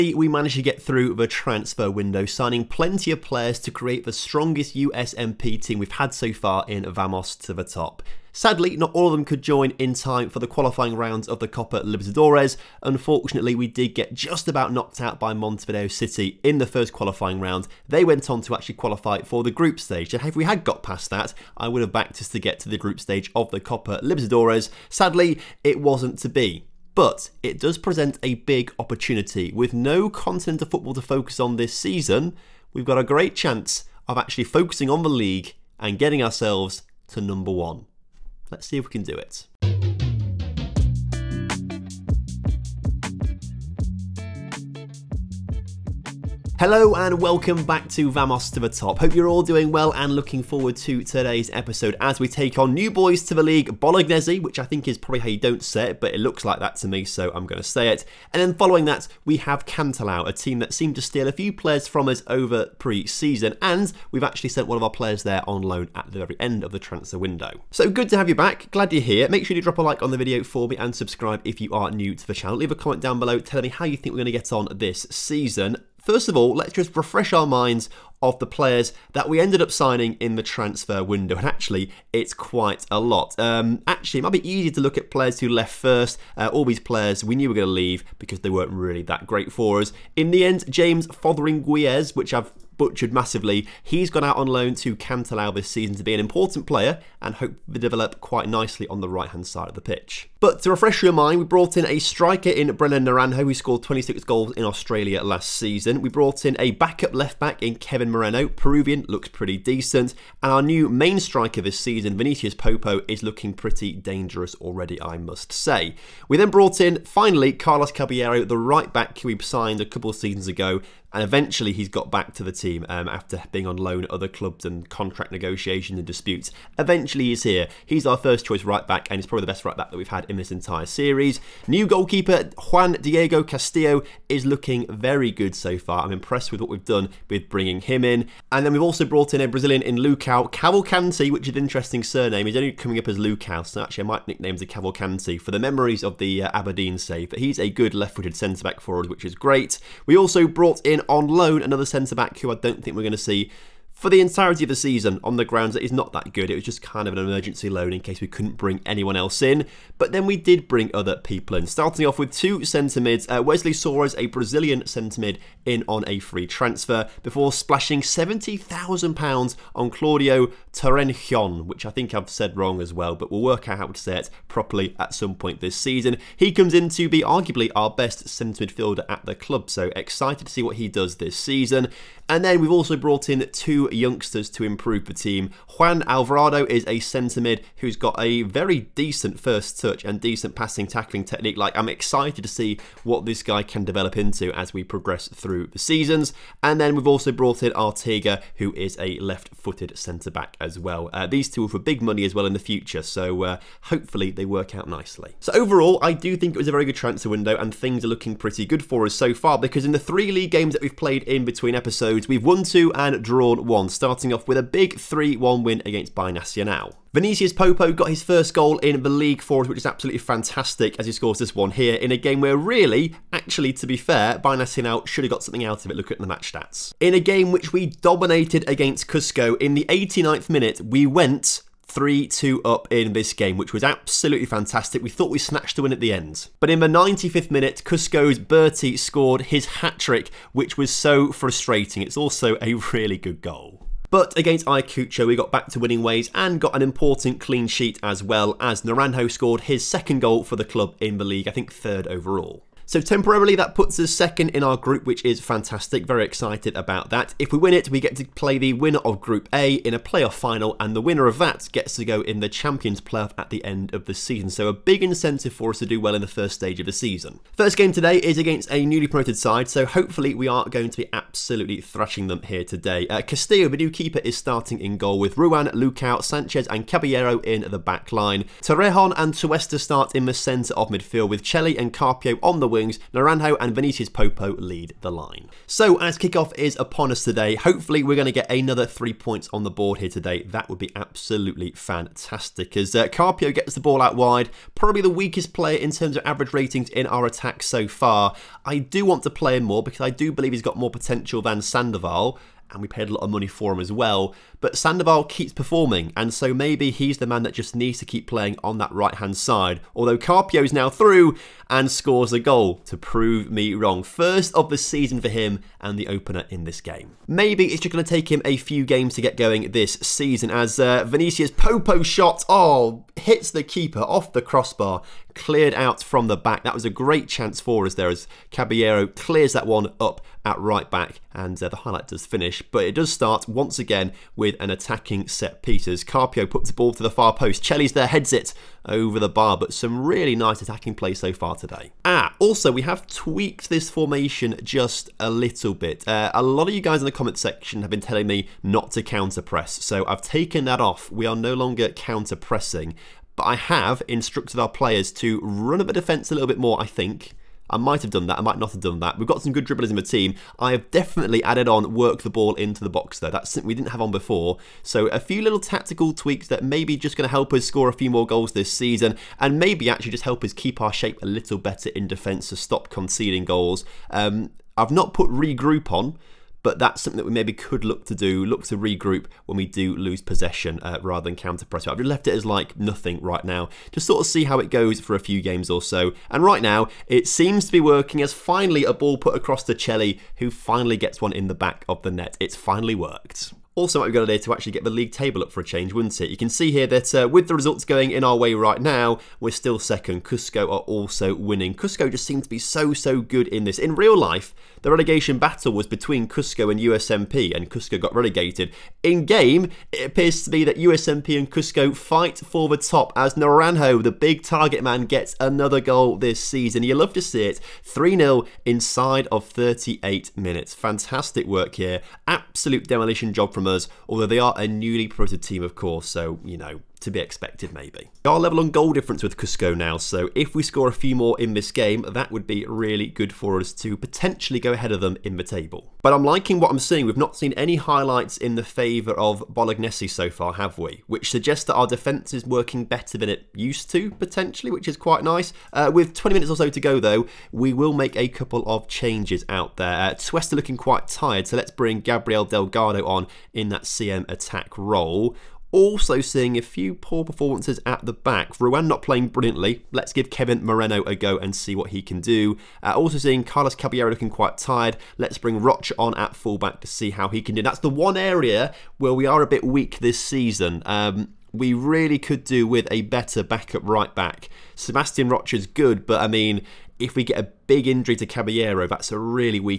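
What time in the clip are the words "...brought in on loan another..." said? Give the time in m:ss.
2:30.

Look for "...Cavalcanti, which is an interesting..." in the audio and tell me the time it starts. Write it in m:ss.
2:20.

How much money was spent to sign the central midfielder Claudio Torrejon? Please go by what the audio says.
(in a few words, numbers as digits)
£70,000.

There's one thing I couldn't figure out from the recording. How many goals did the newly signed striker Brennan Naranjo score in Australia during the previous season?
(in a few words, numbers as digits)
26.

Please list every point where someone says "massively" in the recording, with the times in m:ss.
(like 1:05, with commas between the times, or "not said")
1:33.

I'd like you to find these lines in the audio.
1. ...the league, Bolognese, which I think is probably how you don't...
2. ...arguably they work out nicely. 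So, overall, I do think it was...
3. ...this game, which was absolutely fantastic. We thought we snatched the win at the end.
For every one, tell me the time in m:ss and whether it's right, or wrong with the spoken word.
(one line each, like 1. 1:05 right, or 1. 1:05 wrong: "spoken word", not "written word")
1. 0:53 right
2. 3:23 wrong: "hopefully", not "arguably"
3. 3:53 right.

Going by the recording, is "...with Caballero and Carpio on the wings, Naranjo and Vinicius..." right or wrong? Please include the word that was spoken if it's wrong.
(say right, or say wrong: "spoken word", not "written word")
wrong: "Chelly", not "Caballero".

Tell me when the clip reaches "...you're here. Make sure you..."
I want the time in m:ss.
1:08.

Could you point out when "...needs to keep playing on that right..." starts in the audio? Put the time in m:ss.
5:07.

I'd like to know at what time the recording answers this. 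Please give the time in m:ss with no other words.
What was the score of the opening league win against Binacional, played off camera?
3:34.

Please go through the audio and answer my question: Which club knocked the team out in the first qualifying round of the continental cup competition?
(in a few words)
Montevideo City.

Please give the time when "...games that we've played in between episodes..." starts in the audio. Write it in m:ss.
3:30.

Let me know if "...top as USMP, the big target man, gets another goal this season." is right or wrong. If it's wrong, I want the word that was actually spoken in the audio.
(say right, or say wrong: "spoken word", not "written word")
wrong: "Naranjo", not "USMP".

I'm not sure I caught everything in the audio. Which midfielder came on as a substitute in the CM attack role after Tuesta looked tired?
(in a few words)
Gabriel Delgado.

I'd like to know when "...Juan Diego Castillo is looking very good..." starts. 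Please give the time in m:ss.
2:12.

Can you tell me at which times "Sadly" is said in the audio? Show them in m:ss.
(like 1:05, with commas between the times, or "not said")
0:08, 0:24.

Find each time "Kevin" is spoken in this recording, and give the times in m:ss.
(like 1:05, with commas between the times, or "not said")
1:47, 7:40.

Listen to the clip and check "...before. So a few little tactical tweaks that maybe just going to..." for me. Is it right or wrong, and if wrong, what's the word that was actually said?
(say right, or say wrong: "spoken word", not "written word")
right.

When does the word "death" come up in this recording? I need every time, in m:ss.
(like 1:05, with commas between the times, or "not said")
not said.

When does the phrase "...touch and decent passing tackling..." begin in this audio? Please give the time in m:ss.
3:09.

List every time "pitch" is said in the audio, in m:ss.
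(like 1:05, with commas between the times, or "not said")
1:39.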